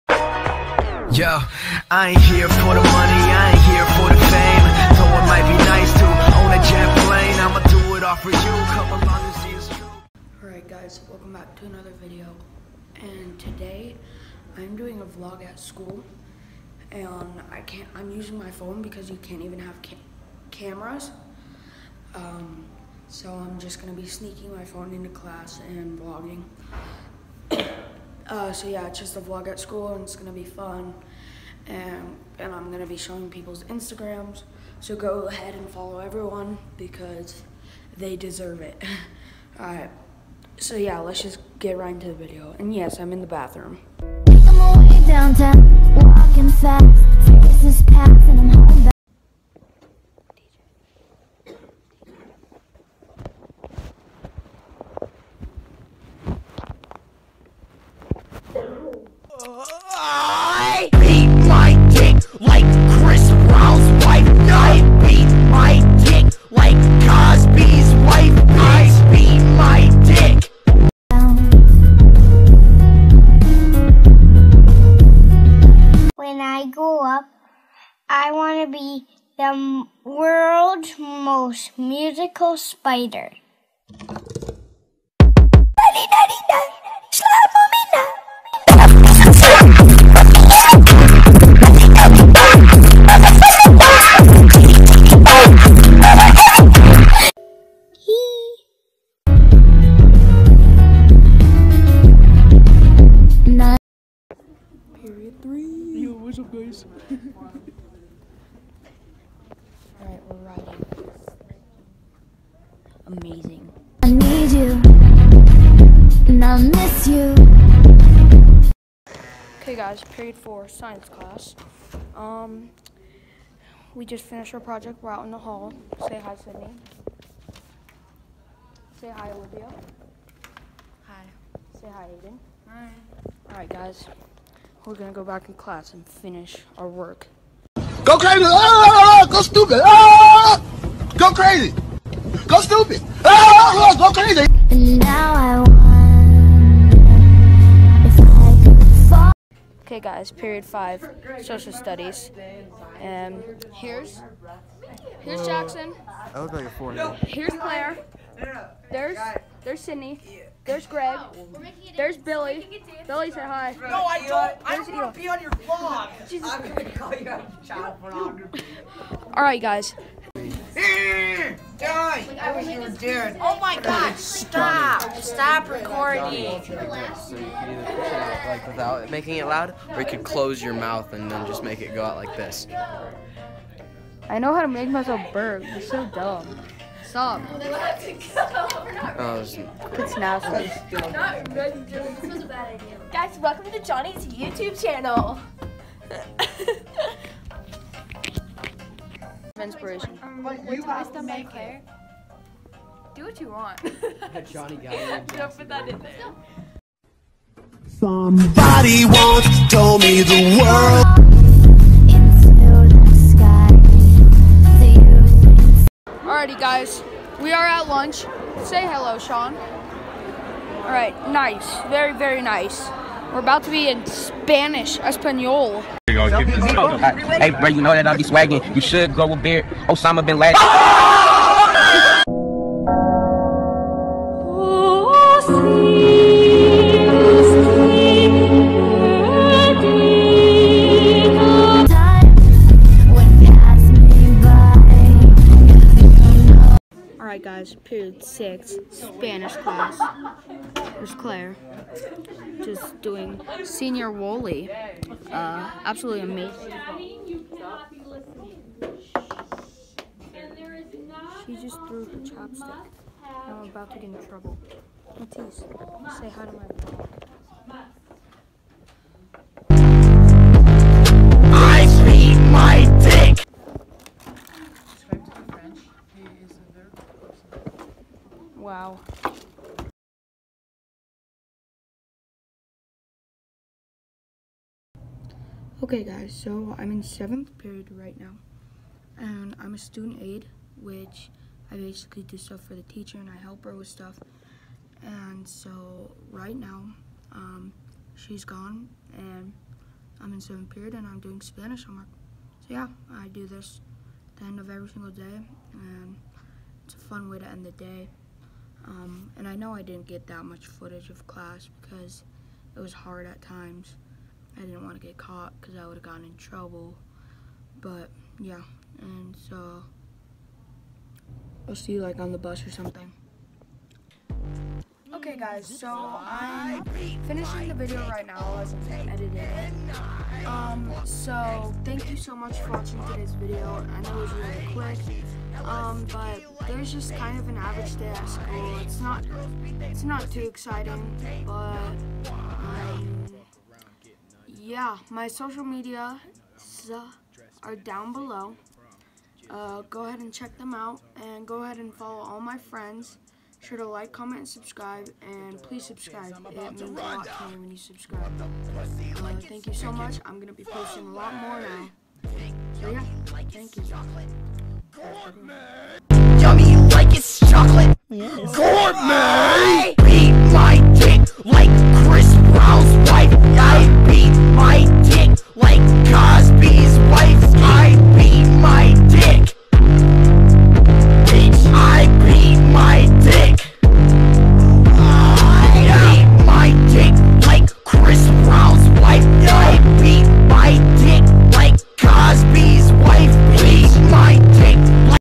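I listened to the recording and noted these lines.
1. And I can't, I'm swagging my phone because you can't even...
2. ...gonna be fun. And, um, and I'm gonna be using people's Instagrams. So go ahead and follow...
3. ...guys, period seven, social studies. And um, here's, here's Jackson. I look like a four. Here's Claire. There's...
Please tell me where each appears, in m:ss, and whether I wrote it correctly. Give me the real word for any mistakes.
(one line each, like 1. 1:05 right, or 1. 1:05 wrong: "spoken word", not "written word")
1. 0:16 wrong: "using", not "swagging"
2. 0:30 wrong: "showing", not "using"
3. 2:30 wrong: "five", not "seven".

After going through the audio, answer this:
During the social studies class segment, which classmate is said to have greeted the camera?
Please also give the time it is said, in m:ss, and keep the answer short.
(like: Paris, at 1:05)
Billy, at 2:43.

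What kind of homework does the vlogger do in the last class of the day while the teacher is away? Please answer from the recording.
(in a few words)
Spanish homework.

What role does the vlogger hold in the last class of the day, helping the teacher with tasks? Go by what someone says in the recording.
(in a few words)
Student aide.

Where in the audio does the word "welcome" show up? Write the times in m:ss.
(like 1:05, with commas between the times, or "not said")
0:11, 3:13.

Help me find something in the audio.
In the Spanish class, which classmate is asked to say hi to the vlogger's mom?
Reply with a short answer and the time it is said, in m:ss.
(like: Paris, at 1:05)
Matisse, at 4:25.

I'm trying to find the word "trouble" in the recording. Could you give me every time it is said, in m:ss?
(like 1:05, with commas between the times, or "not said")
4:24, 5:16.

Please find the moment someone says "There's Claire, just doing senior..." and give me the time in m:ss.
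4:10.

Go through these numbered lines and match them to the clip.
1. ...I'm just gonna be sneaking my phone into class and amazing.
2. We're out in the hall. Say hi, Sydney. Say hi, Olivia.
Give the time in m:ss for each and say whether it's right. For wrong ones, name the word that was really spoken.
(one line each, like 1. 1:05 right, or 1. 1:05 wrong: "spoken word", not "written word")
1. 0:23 wrong: "vlogging", not "amazing"
2. 2:05 right.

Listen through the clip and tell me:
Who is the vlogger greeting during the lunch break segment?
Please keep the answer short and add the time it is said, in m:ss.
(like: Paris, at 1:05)
Sean, at 3:39.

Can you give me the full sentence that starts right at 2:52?
Like, I was oh, you doing?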